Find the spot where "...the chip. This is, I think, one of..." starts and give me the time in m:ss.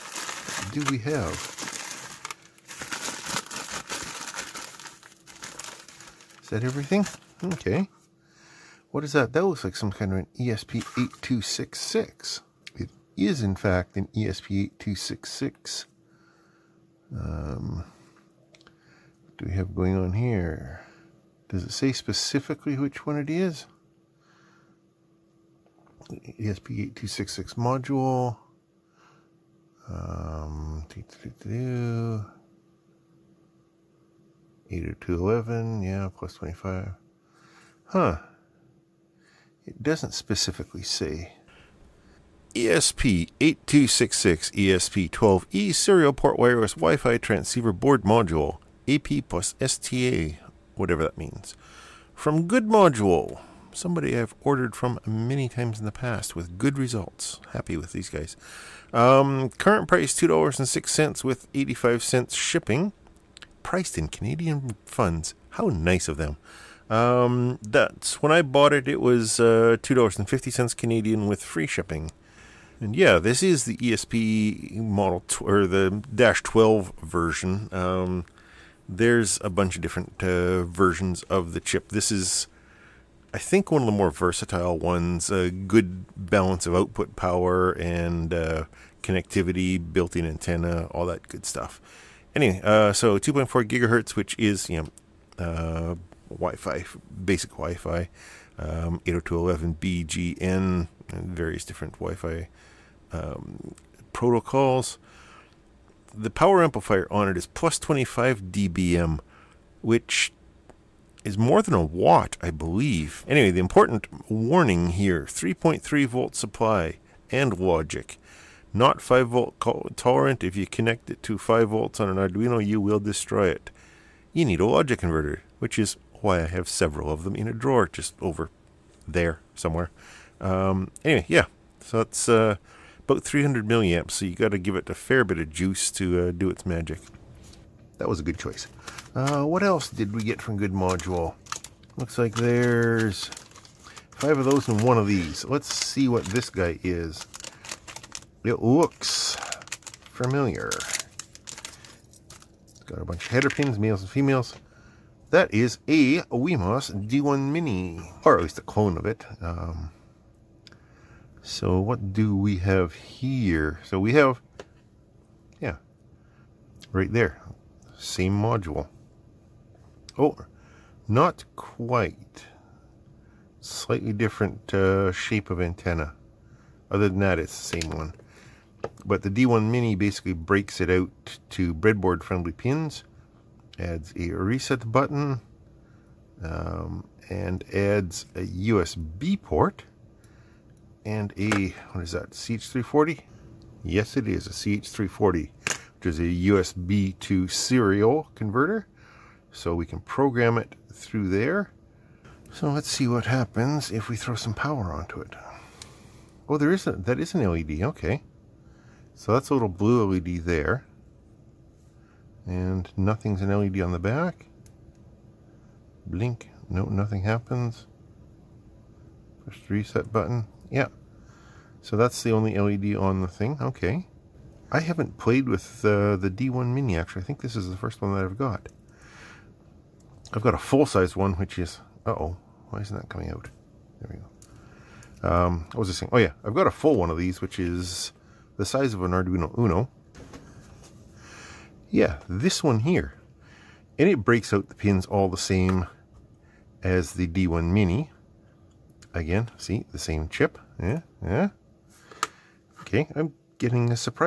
1:21.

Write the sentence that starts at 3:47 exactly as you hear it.
I think this is the first one that I've got.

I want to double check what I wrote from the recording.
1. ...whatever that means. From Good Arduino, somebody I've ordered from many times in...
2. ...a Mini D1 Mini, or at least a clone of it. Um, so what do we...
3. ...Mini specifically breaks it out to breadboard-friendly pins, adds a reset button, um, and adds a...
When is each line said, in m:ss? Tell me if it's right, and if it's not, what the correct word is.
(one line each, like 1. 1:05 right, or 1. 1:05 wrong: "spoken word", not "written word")
1. 0:50 wrong: "Module", not "Arduino"
2. 2:35 wrong: "Wemos", not "Mini"
3. 2:59 wrong: "basically", not "specifically".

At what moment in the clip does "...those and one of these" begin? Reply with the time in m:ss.
2:24.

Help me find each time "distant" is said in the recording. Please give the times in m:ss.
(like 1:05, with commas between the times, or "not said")
not said.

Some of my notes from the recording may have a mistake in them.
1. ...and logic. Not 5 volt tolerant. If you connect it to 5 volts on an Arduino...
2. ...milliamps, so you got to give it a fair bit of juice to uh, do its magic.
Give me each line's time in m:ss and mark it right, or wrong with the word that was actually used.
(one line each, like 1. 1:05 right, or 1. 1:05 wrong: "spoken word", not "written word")
1. 1:57 right
2. 2:13 right.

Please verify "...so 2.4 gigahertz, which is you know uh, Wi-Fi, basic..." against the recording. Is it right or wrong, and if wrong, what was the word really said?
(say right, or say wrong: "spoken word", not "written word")
right.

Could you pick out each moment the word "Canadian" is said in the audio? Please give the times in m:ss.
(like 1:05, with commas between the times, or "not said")
1:04, 1:10.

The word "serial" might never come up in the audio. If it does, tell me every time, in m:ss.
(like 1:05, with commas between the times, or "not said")
0:45, 3:17.